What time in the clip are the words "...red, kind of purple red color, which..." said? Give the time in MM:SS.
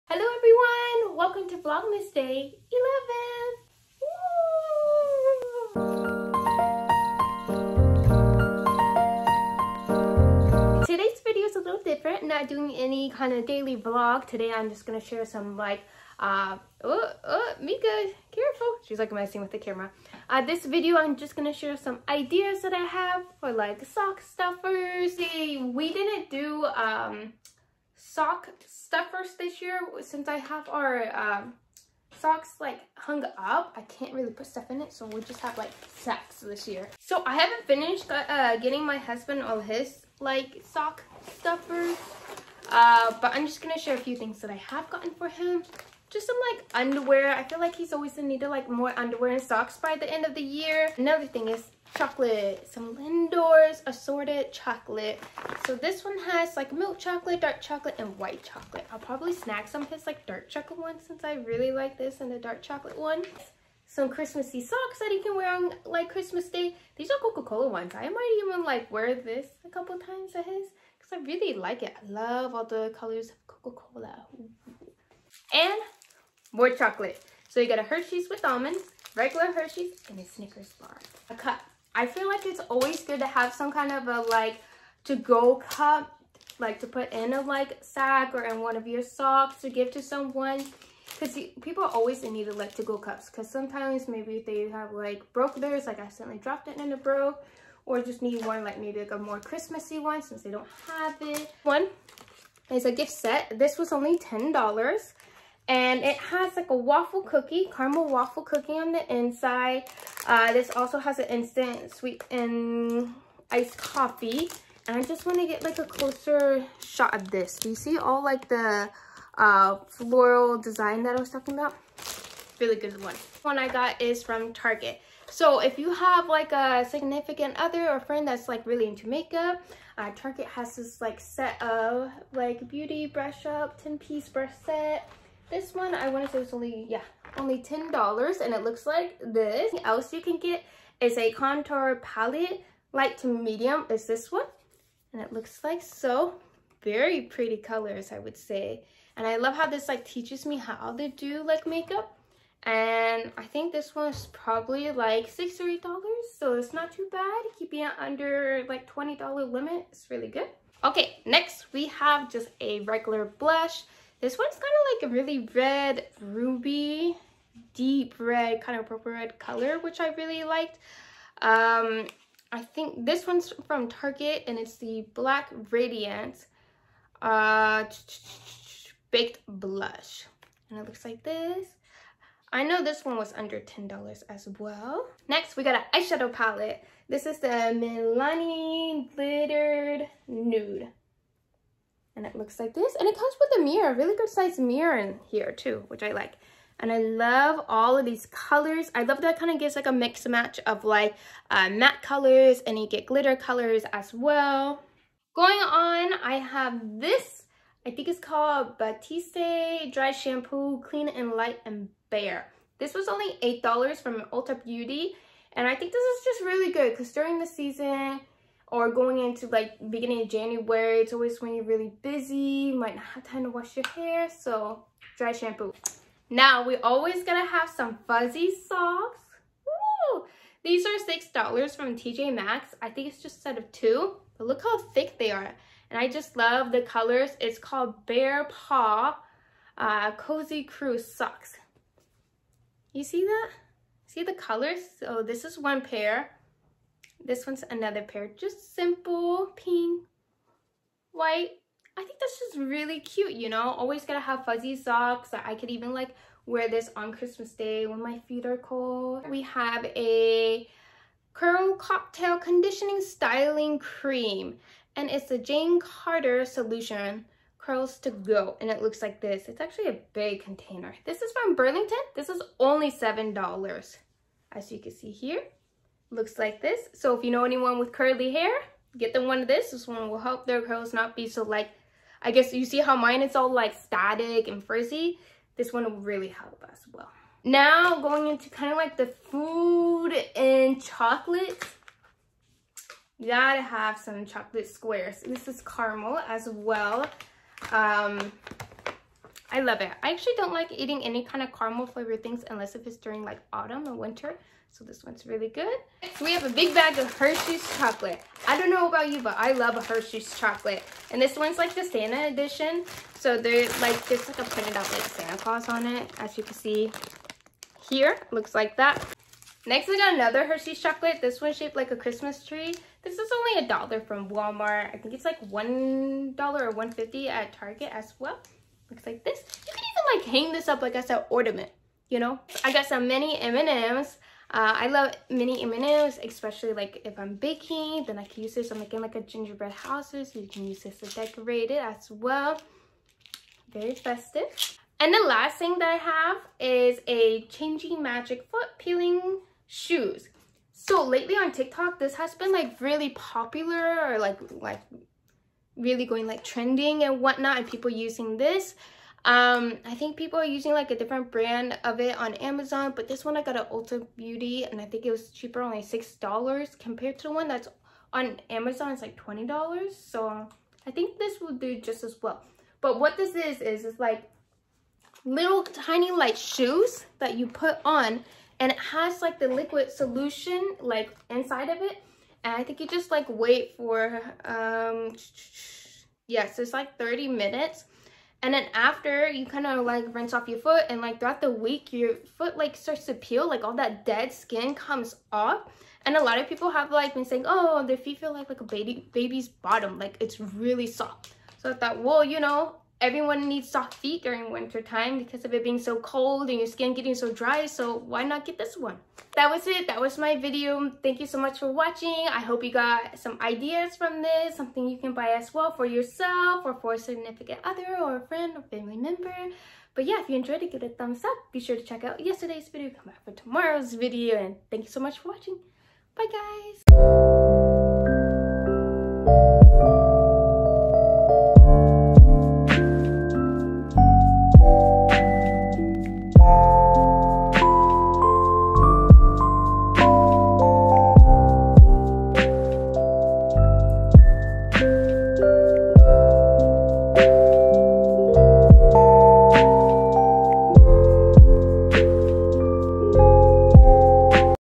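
02:48.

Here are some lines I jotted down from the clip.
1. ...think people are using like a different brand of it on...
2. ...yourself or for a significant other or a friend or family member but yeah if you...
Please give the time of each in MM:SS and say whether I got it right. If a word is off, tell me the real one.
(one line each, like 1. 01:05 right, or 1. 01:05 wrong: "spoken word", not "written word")
1. 05:59 right
2. 06:55 right.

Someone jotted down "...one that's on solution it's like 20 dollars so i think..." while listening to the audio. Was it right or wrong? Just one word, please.
wrong.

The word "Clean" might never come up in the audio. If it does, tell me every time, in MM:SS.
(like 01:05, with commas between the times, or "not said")
03:30.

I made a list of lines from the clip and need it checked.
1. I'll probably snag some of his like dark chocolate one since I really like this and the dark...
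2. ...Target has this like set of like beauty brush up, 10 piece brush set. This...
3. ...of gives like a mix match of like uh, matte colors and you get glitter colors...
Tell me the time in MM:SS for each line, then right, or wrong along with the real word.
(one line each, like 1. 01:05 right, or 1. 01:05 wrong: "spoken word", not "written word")
1. 00:58 right
2. 02:10 right
3. 03:19 right.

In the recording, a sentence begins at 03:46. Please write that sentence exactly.
Now, we always going to have some fuzzy socks.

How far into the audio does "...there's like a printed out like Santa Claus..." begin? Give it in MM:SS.
05:14.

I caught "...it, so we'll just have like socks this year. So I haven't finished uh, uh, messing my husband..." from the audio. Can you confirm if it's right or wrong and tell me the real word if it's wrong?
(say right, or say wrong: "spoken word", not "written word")
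wrong: "getting", not "messing".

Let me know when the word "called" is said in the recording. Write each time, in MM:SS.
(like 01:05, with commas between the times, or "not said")
03:28, 03:57.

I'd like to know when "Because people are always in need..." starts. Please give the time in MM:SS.
01:31.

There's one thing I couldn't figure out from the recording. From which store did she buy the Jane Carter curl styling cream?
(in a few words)
Burlington.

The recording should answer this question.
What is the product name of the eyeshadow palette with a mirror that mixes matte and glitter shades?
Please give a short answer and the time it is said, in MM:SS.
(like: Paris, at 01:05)
Milani Glittered Nude, at 03:07.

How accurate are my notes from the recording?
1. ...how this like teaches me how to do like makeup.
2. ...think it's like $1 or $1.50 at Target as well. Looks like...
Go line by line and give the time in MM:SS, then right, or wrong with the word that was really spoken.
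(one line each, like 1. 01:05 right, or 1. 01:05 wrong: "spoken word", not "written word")
1. 02:29 right
2. 05:24 right.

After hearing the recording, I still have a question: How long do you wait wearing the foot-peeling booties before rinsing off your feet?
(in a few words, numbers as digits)
30 minutes.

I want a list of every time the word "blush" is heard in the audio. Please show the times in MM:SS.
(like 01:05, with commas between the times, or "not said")
02:43, 02:59.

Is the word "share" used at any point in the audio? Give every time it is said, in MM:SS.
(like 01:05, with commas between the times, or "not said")
00:14, 00:21, 00:43.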